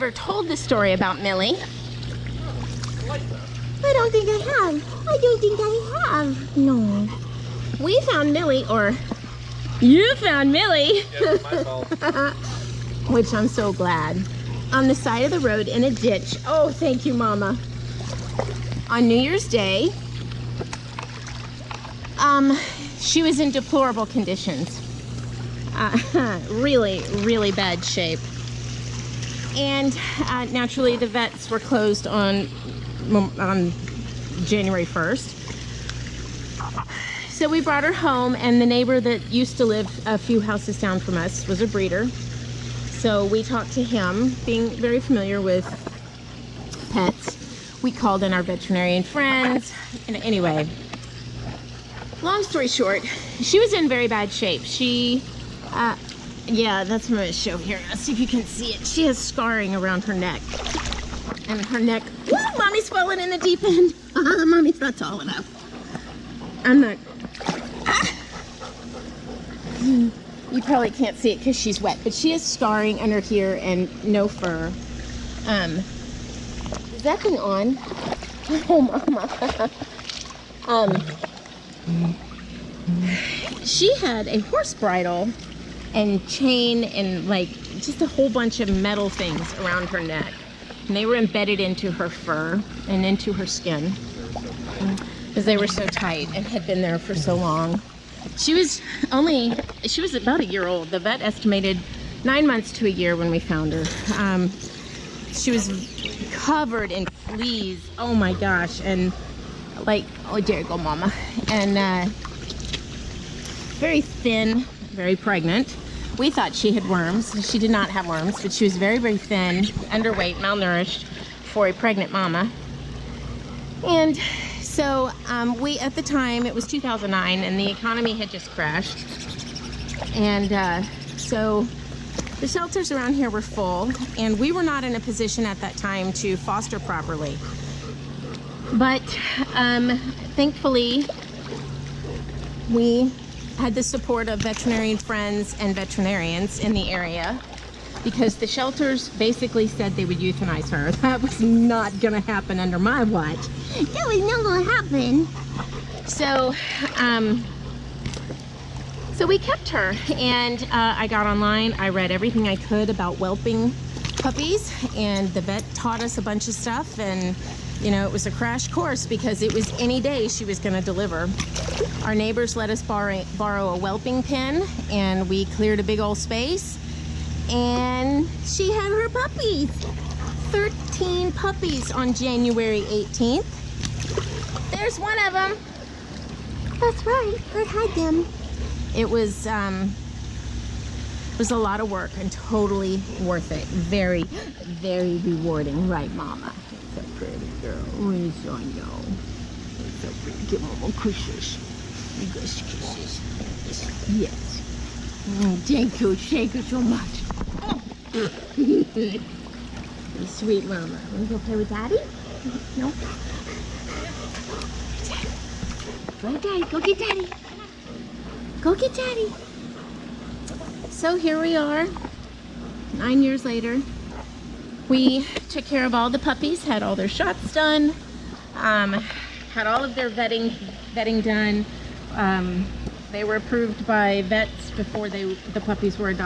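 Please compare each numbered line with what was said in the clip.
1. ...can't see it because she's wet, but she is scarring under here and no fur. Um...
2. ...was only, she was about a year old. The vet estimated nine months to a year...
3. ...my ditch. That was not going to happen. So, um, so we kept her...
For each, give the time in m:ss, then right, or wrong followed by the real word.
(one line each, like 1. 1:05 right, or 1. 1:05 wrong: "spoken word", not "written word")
1. 1:10 right
2. 1:38 right
3. 2:32 wrong: "watch", not "ditch".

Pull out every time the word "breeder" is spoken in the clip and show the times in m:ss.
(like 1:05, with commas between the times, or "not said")
0:41.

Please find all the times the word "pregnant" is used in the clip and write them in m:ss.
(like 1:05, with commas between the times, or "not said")
1:55, 2:01.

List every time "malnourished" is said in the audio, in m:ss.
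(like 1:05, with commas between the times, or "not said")
2:00.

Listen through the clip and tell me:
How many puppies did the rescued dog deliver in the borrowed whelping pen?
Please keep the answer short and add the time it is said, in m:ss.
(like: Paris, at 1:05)
13, at 3:00.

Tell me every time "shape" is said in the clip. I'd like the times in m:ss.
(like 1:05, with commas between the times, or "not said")
0:27, 0:54.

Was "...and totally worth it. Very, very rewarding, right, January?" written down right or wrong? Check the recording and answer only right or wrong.
wrong.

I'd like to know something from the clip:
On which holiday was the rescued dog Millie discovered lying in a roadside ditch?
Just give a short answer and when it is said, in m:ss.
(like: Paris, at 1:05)
New Year's Day, at 0:19.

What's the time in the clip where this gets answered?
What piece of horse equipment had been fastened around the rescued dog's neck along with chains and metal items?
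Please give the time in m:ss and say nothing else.
1:24.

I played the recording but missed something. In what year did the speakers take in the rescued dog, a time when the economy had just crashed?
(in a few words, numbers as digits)
2009.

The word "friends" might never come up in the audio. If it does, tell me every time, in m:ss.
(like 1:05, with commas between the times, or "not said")
0:49, 2:24.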